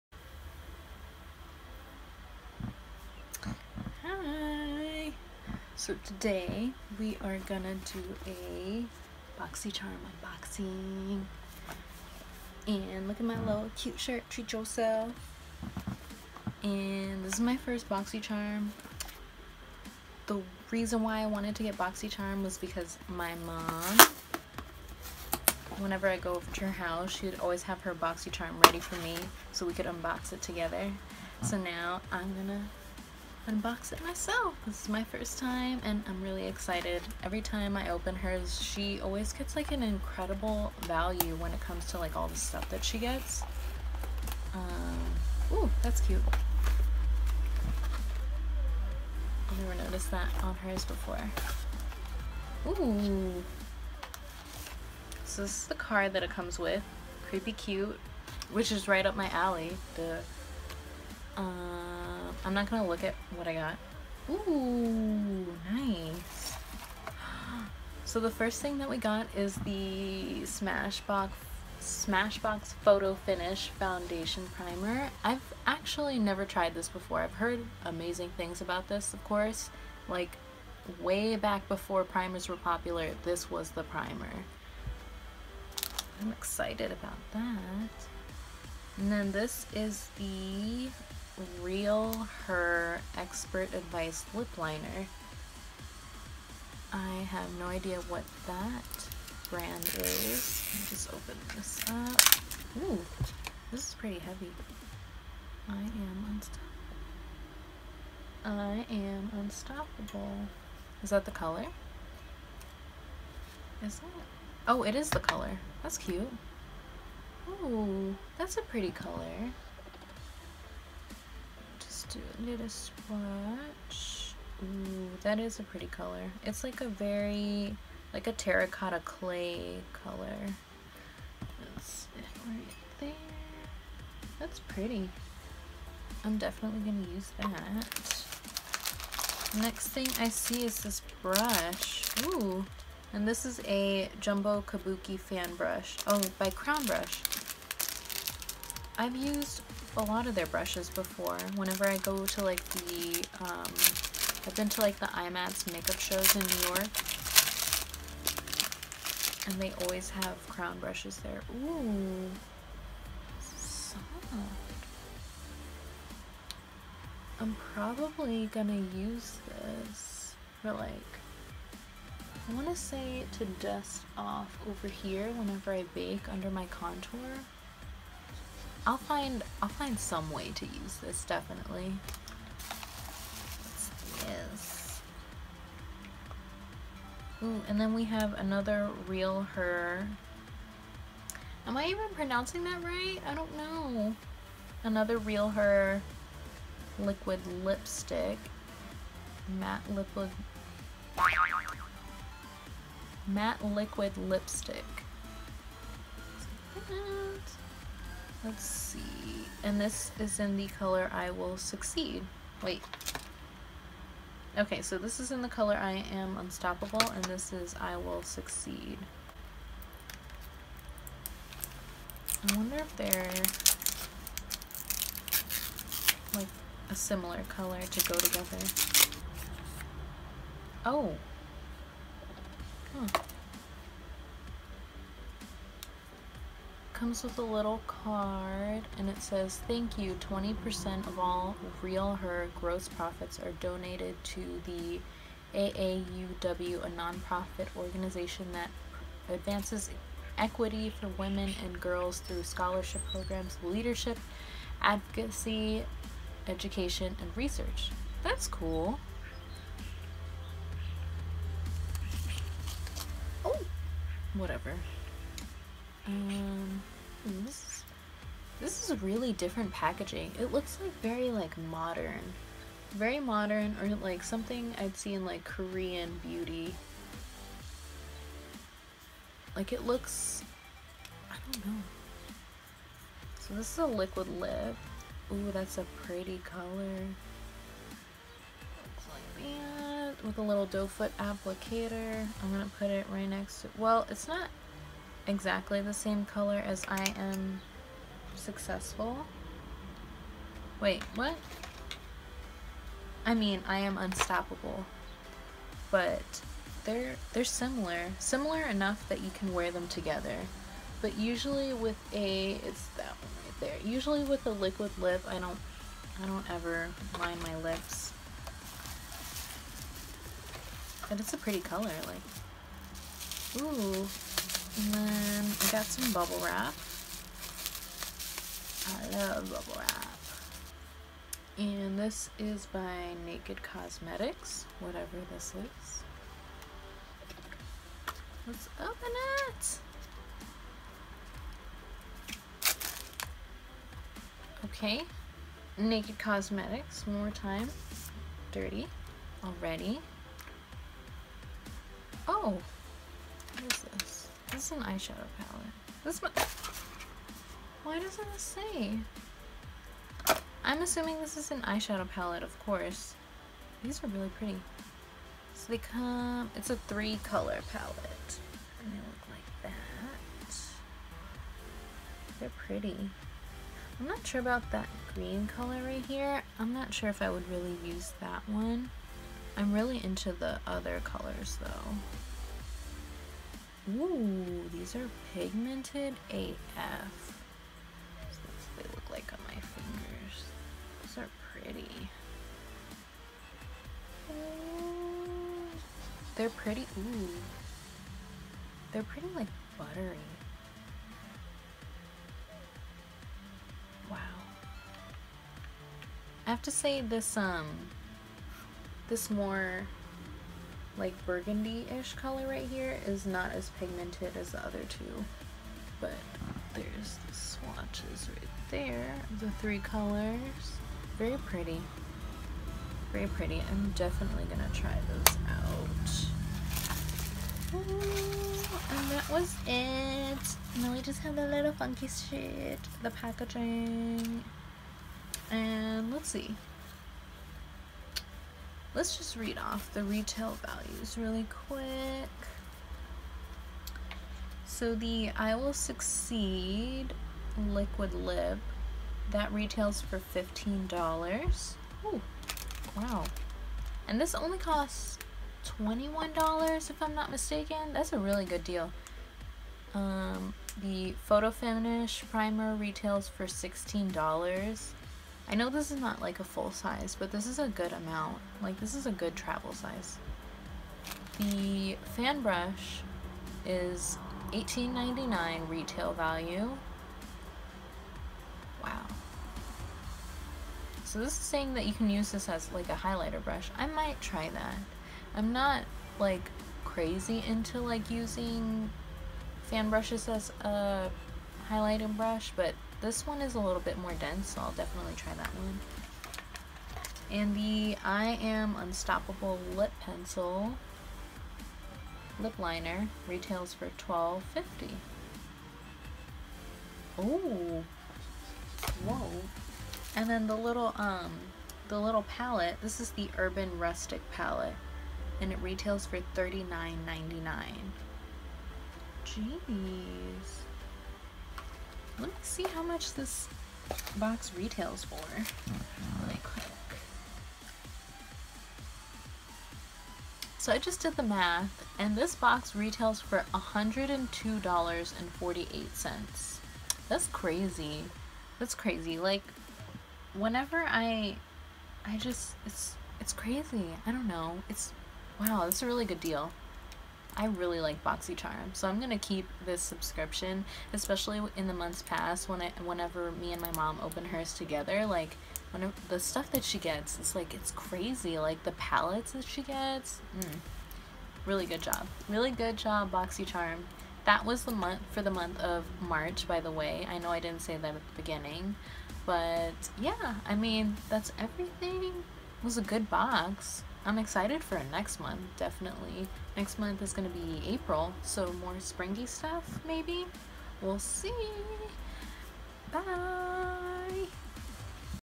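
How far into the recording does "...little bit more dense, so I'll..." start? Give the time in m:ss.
8:13.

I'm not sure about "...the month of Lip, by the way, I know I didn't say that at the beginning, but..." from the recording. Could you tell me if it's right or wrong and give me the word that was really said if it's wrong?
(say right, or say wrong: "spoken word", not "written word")
wrong: "March", not "Lip".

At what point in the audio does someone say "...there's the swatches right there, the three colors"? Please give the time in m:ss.
6:56.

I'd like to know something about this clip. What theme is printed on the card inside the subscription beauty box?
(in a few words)
Creepy cute.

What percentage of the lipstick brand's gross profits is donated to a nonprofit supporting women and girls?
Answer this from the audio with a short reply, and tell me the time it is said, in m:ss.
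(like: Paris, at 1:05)
20%, at 4:00.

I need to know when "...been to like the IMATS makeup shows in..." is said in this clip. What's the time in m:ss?
2:34.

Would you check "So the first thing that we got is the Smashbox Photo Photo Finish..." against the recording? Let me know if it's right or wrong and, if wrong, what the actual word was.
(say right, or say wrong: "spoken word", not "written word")
wrong: "Smashbox", not "Photo".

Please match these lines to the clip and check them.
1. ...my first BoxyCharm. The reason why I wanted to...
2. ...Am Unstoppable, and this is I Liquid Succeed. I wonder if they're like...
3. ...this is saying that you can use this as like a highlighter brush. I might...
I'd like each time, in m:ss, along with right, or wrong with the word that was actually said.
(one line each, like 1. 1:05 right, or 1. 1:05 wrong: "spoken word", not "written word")
1. 0:17 right
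2. 3:36 wrong: "Will", not "Liquid"
3. 8:01 right.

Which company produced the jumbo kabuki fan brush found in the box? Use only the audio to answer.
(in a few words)
Crown Brush.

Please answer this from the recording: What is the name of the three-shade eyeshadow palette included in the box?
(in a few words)
Urban Rustic.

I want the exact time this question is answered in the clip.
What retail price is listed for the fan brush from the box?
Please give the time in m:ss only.
7:54.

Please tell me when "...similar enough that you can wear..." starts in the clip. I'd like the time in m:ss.
5:08.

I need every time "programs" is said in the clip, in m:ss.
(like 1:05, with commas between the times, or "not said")
4:13.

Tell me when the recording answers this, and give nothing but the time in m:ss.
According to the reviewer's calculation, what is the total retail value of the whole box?
8:53.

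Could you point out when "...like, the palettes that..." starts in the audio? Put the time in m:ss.
9:18.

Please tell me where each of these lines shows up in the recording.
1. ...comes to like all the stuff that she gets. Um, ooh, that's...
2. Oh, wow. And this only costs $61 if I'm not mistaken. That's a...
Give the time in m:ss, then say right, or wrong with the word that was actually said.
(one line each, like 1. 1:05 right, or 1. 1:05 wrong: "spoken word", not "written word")
1. 0:41 right
2. 7:32 wrong: "21", not "61".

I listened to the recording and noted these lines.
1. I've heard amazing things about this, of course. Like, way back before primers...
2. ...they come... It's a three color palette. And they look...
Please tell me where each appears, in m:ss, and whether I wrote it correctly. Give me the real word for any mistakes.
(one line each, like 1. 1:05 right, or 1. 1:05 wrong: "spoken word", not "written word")
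1. 1:17 right
2. 6:05 right.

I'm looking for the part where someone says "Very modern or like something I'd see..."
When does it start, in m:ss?
4:32.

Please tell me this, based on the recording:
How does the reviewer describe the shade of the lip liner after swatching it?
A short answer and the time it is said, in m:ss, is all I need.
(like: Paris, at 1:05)
Terracotta clay, at 2:08.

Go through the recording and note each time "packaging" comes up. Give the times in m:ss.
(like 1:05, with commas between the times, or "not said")
4:29, 7:13.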